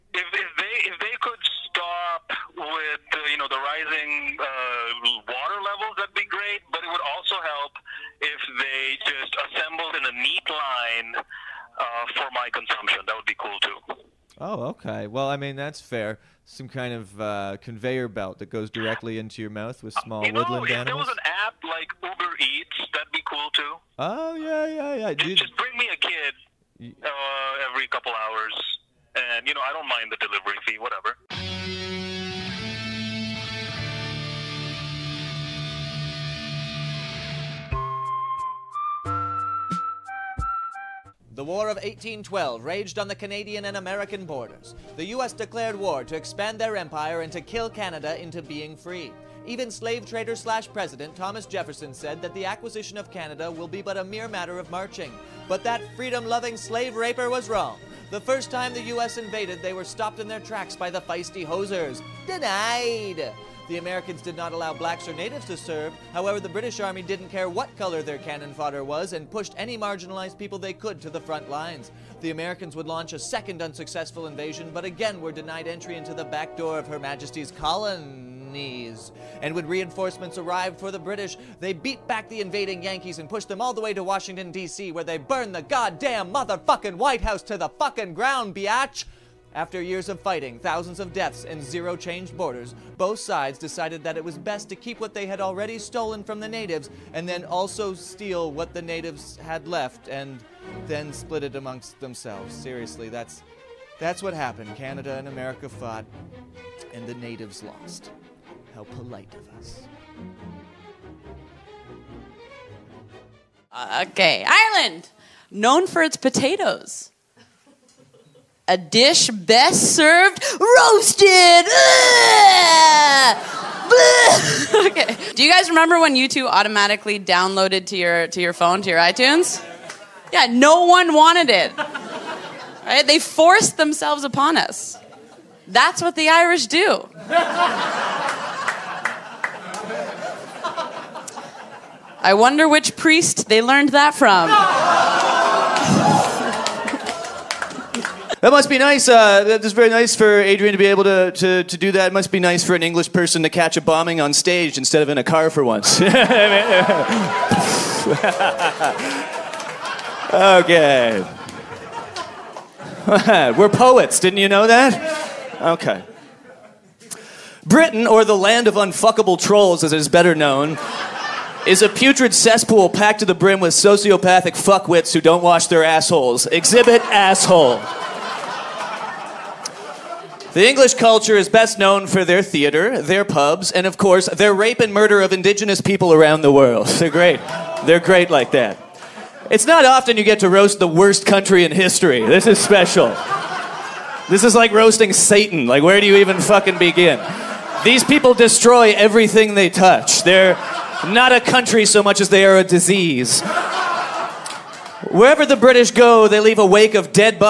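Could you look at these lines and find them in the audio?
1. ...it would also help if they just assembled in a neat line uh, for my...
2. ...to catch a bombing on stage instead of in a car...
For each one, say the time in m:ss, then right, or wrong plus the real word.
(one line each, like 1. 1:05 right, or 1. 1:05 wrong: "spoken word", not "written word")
1. 0:06 right
2. 2:33 right.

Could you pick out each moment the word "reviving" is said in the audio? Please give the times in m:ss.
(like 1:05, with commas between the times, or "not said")
not said.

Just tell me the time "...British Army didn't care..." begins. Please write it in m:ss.
1:06.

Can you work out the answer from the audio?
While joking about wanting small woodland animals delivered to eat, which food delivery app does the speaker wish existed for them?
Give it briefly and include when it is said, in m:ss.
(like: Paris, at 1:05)
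Uber Eats, at 0:22.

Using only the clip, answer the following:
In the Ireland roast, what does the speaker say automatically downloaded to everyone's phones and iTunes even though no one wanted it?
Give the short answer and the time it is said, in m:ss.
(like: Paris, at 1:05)
YouTube, at 2:06.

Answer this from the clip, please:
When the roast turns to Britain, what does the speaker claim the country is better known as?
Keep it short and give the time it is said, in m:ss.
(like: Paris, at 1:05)
the land of unfuckable trolls, at 2:48.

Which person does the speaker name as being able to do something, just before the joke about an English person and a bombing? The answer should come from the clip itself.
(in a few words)
Adrian.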